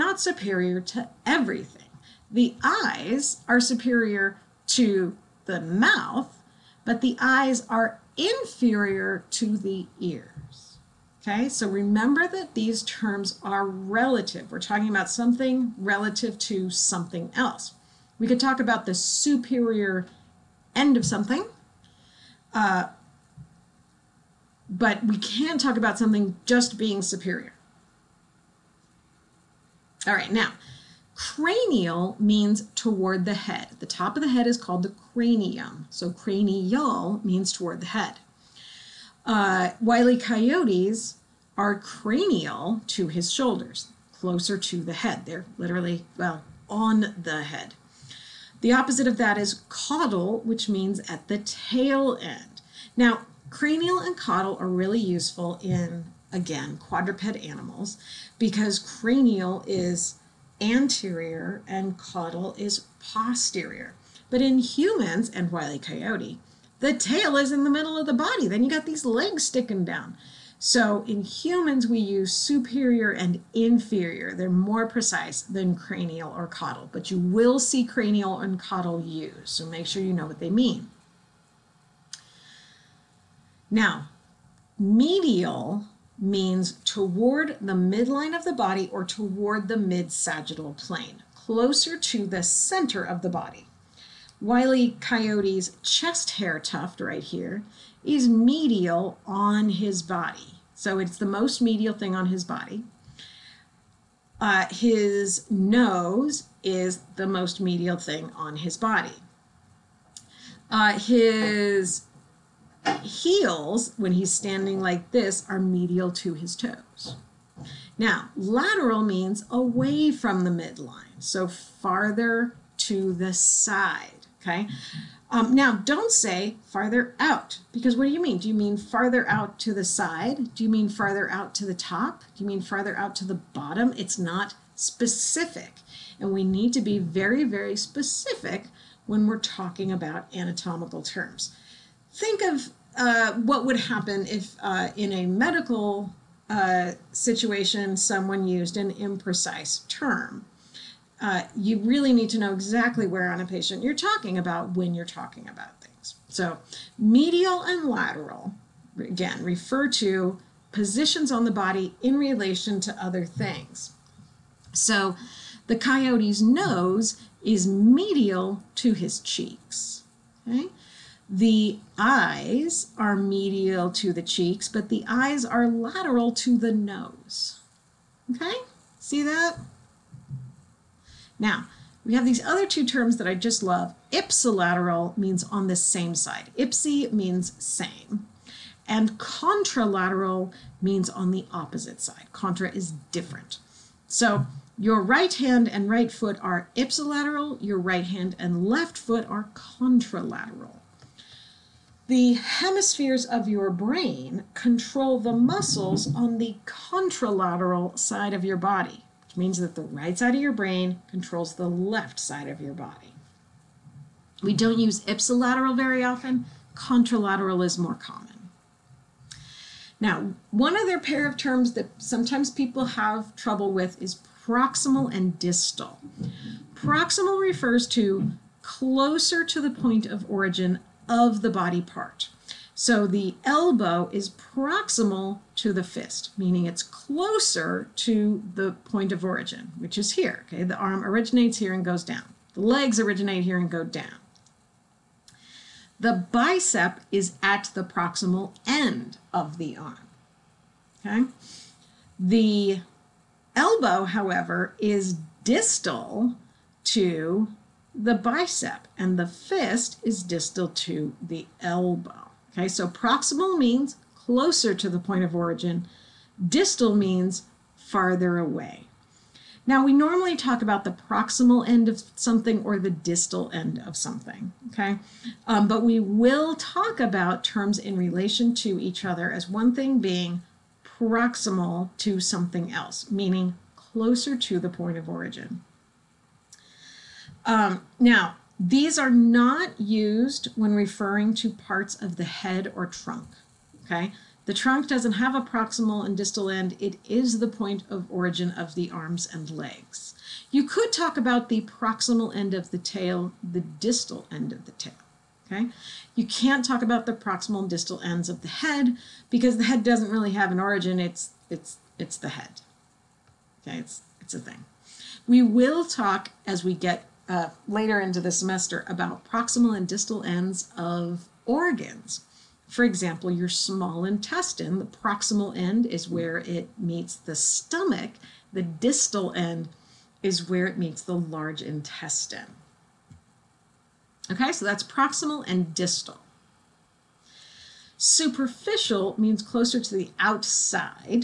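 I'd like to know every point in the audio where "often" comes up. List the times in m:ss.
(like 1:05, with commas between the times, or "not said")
3:36.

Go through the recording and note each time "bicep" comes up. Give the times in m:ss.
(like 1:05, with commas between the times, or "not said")
4:06, 4:18.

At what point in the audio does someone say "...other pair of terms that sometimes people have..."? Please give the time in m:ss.
3:40.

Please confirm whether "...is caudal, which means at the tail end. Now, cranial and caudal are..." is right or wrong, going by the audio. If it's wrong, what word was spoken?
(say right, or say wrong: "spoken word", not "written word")
right.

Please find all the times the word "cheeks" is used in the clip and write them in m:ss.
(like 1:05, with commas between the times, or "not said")
2:49, 2:54.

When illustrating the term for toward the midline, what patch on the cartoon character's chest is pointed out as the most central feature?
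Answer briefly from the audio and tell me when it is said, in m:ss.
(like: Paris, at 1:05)
chest hair tuft, at 1:35.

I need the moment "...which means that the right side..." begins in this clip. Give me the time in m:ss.
3:29.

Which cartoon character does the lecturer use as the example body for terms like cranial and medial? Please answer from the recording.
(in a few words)
Wile E. Coyote.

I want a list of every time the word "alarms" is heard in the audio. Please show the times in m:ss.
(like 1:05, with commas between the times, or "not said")
not said.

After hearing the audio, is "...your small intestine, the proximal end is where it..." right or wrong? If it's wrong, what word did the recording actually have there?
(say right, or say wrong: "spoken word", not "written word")
right.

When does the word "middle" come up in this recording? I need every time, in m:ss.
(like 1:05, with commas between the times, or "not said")
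1:07.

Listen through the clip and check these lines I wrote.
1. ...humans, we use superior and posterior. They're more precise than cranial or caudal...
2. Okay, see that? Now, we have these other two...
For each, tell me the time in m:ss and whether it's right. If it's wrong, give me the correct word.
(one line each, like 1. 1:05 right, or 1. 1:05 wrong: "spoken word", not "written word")
1. 1:11 wrong: "inferior", not "posterior"
2. 2:58 right.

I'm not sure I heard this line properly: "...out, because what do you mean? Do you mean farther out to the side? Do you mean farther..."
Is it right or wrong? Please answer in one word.
right.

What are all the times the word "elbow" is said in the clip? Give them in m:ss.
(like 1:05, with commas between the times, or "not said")
3:53, 4:13, 4:21.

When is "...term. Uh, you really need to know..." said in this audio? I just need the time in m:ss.
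2:29.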